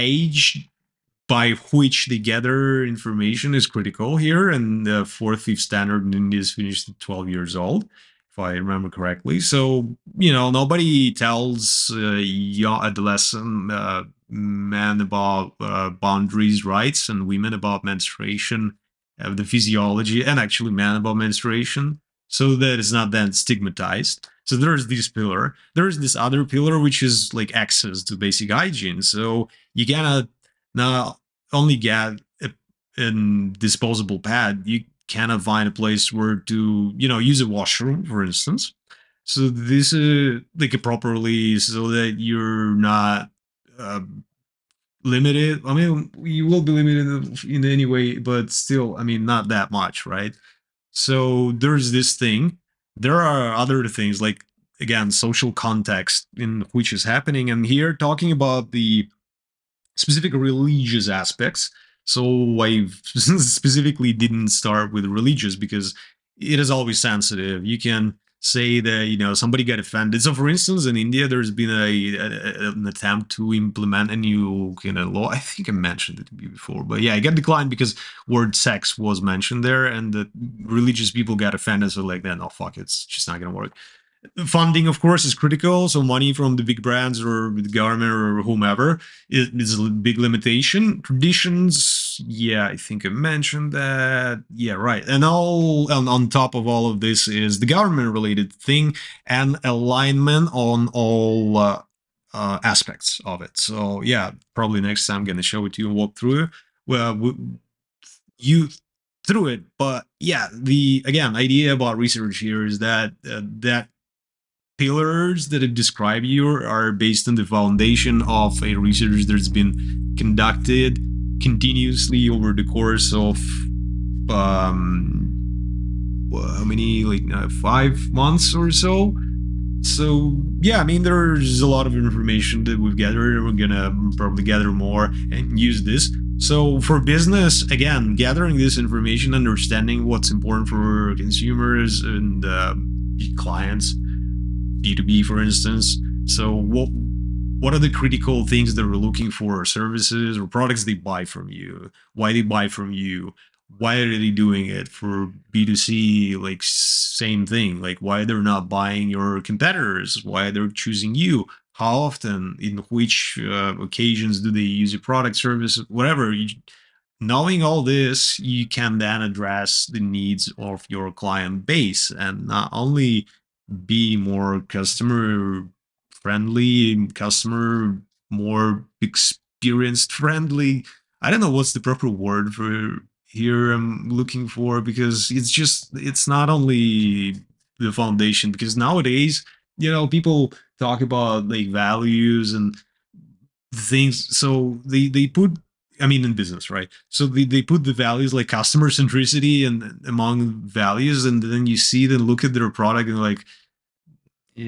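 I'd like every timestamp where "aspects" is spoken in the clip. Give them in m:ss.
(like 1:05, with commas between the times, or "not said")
1:01, 1:42.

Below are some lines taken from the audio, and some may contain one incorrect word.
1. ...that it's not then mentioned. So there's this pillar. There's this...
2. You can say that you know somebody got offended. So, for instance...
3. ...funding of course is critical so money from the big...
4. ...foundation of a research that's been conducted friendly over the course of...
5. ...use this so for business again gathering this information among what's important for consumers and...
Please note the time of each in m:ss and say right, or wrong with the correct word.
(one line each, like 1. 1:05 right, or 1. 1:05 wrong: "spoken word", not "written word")
1. 0:22 wrong: "stigmatized", not "mentioned"
2. 1:07 right
3. 1:24 right
4. 1:57 wrong: "continuously", not "friendly"
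5. 2:15 wrong: "understanding", not "among".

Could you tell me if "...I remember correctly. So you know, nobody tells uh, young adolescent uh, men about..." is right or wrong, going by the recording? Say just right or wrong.
right.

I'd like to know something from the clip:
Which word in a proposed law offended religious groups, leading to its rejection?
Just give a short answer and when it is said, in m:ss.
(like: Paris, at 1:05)
sex, at 1:18.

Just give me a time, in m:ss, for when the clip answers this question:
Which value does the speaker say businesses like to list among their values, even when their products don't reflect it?
3:18.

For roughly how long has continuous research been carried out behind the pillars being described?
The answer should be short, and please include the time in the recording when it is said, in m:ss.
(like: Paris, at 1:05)
5 months, at 2:07.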